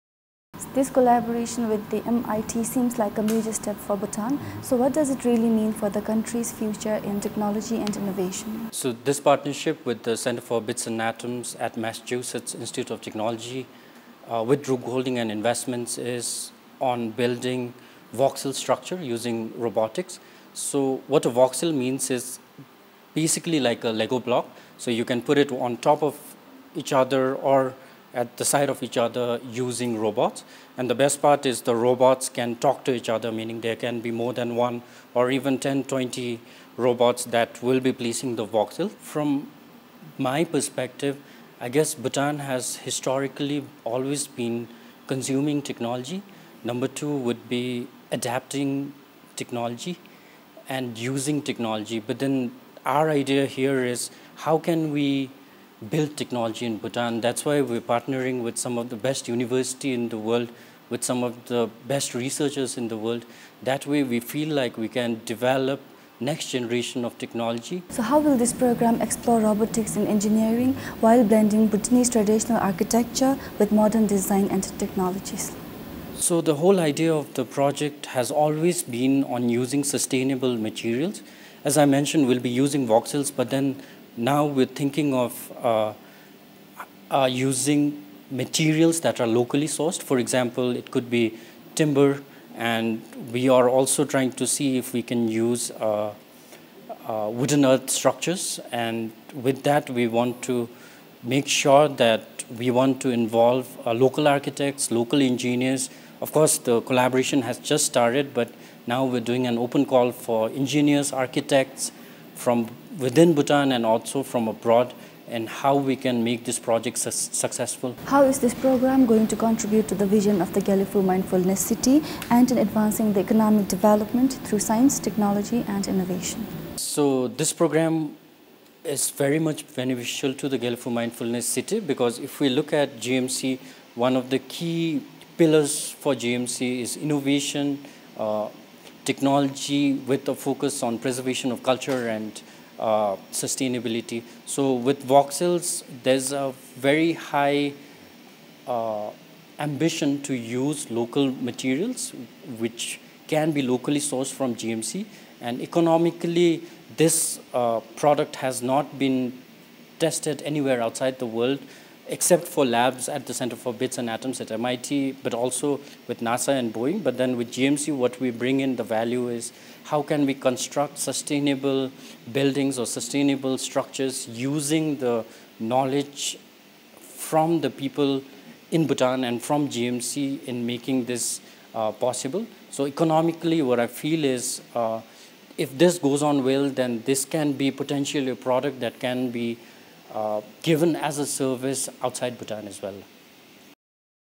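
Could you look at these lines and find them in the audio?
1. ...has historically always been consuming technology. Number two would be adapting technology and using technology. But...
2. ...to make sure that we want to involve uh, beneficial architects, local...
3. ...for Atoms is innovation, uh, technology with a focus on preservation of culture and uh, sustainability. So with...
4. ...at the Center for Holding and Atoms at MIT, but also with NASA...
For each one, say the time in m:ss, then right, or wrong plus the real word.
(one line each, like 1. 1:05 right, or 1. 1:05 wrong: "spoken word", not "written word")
1. 0:42 right
2. 1:40 wrong: "local", not "beneficial"
3. 2:16 wrong: "GMC", not "Atoms"
4. 2:43 wrong: "Bits", not "Holding".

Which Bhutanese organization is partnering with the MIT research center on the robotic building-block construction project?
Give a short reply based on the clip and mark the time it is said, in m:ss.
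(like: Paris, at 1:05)
Druk Holding and Investments, at 0:14.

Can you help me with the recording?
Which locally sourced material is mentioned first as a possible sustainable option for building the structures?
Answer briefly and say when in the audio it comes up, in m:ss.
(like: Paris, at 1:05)
Timber, at 1:31.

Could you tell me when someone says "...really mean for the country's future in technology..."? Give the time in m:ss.
0:05.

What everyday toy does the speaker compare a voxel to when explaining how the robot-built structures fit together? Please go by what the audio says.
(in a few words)
Lego block.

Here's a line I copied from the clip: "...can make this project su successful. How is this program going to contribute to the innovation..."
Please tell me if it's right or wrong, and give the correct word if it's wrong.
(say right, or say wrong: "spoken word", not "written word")
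wrong: "vision", not "innovation".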